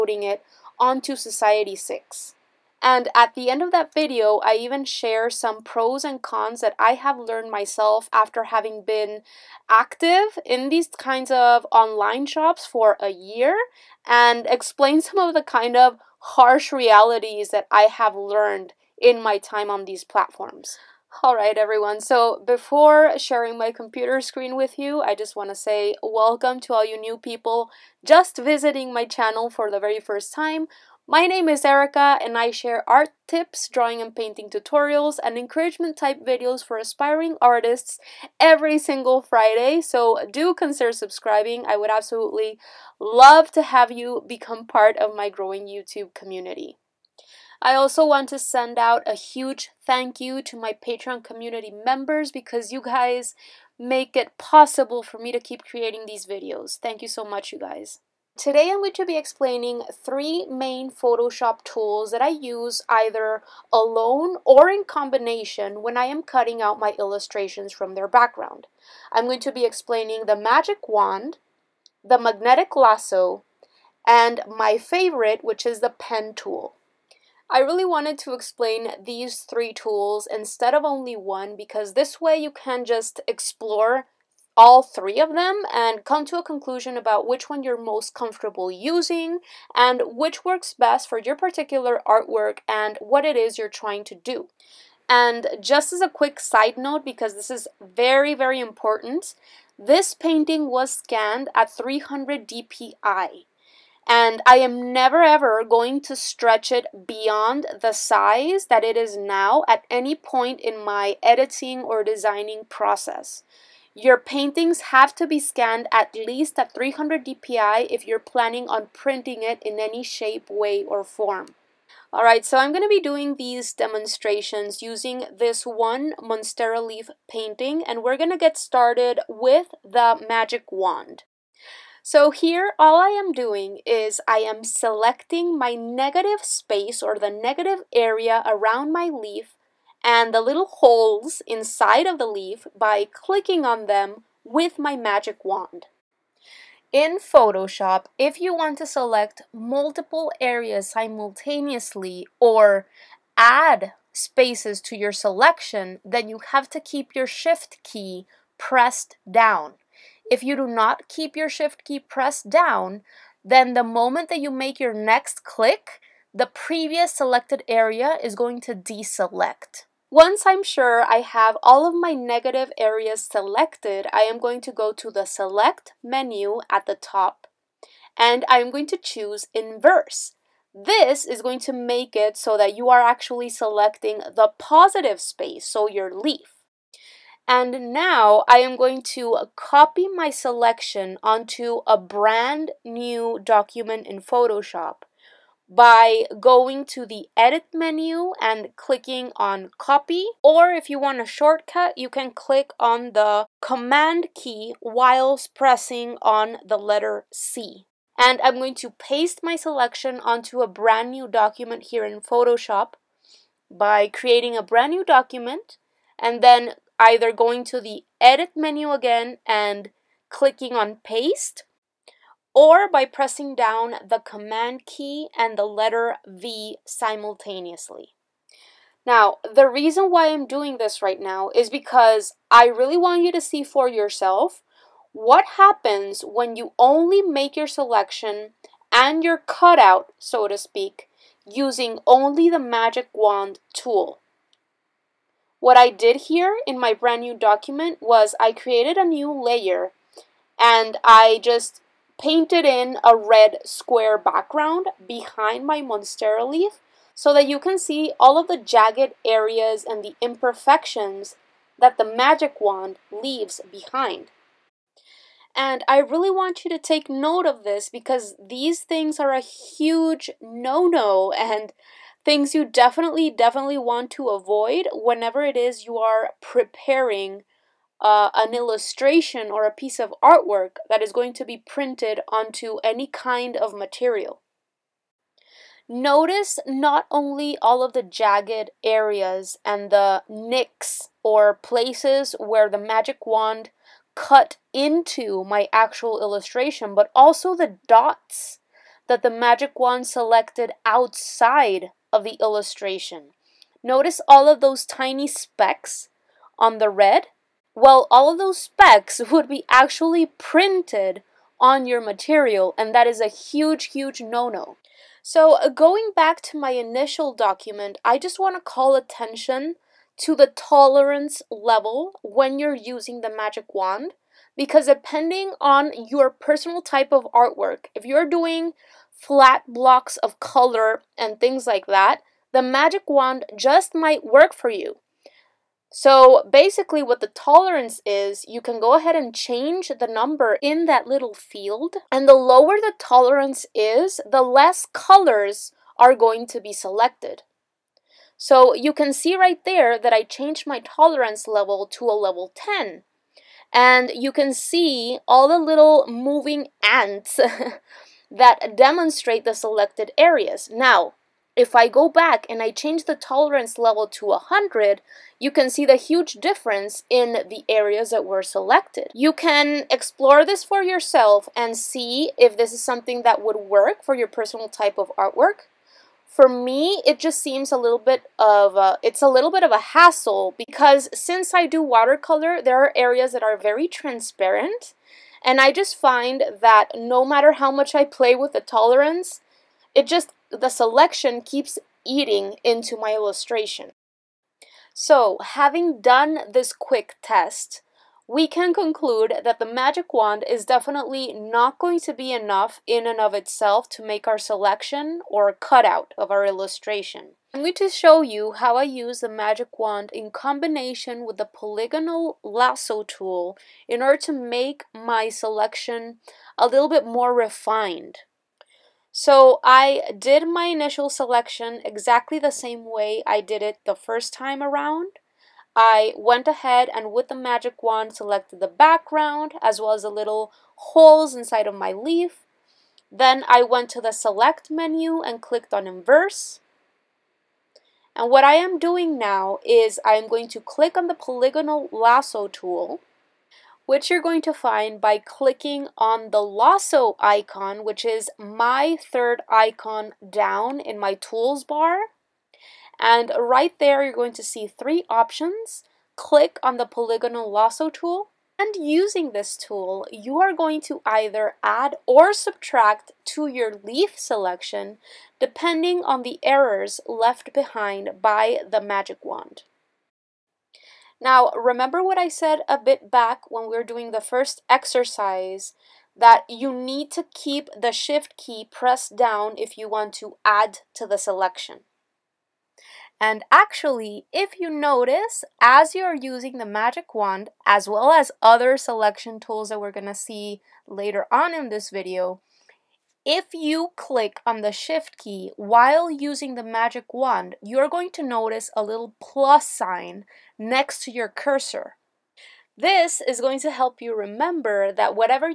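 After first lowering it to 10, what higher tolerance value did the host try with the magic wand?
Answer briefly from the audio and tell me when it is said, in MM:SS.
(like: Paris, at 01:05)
100, at 06:04.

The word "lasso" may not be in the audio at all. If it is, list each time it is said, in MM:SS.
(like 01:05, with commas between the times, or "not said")
01:12, 06:52, 07:21, 07:26, 07:37.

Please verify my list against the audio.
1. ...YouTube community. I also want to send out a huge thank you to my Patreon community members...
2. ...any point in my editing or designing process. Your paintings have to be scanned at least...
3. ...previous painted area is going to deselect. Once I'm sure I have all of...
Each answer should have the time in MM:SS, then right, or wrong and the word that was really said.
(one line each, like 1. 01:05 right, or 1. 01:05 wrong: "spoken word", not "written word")
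1. 00:45 right
2. 01:49 right
3. 02:46 wrong: "selected", not "painted".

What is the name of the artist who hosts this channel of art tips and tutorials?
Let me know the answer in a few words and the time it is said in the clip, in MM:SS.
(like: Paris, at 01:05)
Erika, at 00:31.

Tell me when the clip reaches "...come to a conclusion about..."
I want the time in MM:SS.
01:26.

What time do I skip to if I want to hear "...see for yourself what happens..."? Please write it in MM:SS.
03:53.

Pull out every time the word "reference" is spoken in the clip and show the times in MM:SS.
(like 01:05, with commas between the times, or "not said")
not said.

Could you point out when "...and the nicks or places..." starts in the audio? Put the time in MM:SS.
04:49.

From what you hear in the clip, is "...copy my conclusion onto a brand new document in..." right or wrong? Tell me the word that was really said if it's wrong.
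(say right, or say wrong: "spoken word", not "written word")
wrong: "selection", not "conclusion".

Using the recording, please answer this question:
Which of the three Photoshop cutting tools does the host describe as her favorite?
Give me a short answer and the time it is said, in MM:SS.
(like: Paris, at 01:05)
pen tool, at 01:15.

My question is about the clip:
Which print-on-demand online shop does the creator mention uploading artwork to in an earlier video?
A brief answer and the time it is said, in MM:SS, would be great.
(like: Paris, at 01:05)
Society 6, at 00:01.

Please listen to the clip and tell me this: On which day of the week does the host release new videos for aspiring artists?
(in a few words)
Friday.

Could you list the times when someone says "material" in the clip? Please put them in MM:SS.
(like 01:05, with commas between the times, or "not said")
04:43, 05:11.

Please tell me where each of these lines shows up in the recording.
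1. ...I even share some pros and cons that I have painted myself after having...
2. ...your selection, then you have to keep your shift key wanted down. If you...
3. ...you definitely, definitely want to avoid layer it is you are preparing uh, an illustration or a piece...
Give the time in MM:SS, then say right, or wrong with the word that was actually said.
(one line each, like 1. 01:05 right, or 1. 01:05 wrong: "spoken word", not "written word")
1. 00:04 wrong: "learned", not "painted"
2. 02:34 wrong: "pressed", not "wanted"
3. 04:32 wrong: "whenever", not "layer".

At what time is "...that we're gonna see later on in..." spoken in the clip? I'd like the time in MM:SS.
08:09.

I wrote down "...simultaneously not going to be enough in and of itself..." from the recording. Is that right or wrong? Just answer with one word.
wrong.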